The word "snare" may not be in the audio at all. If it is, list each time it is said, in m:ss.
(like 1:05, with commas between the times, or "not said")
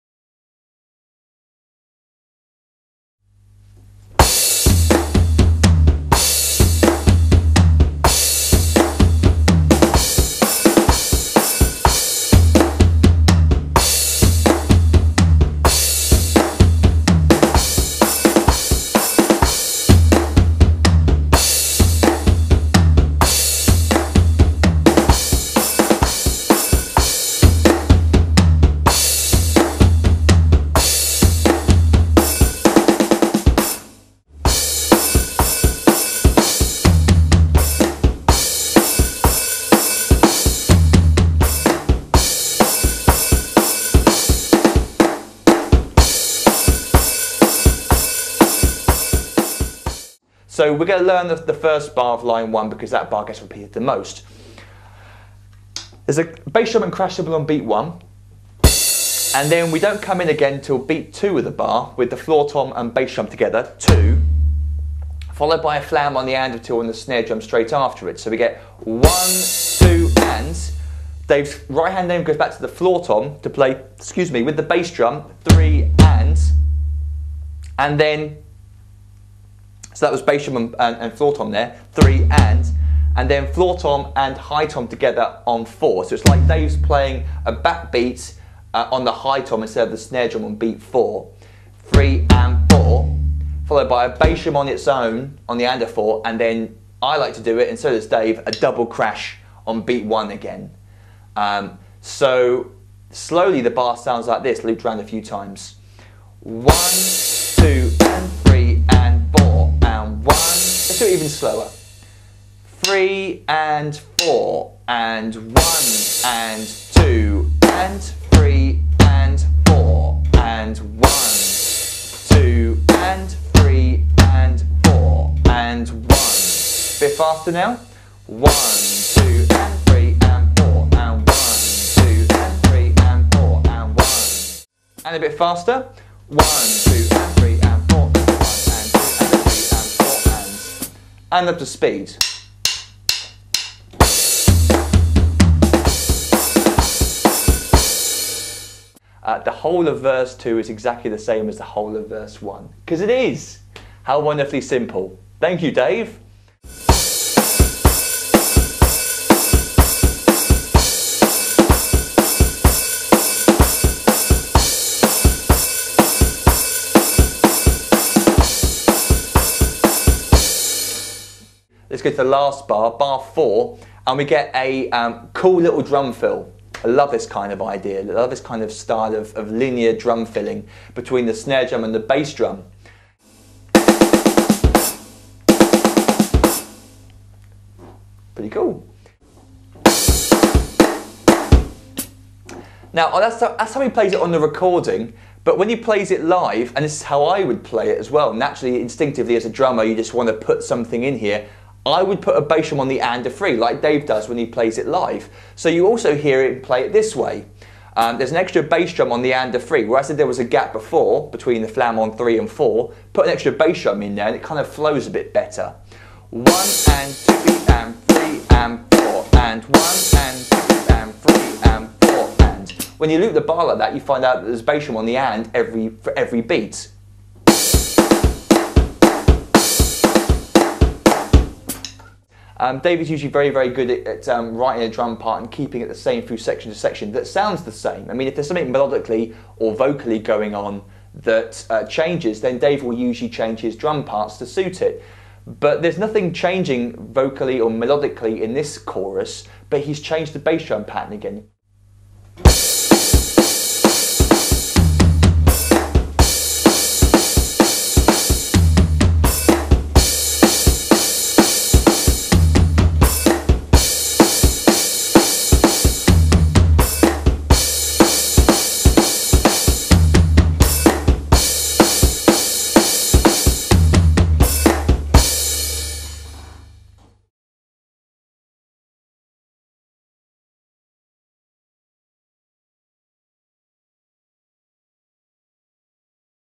1:06, 1:29, 3:01.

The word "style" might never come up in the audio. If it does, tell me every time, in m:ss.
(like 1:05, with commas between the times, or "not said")
2:58.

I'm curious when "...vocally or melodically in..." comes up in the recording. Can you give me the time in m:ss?
4:07.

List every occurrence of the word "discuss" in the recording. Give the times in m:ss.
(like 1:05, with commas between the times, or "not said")
not said.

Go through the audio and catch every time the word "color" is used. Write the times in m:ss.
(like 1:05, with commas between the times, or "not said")
not said.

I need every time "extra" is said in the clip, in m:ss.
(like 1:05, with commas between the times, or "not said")
3:28, 3:33.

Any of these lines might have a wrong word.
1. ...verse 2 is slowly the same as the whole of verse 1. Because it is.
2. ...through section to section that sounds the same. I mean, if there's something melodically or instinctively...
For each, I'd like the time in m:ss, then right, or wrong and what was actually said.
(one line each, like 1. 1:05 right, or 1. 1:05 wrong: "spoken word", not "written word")
1. 2:30 wrong: "exactly", not "slowly"
2. 3:56 wrong: "vocally", not "instinctively".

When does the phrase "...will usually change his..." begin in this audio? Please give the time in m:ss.
4:02.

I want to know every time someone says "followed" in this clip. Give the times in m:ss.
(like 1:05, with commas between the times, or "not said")
1:05, 1:33.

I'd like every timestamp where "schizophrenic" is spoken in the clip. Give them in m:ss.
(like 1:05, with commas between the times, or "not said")
not said.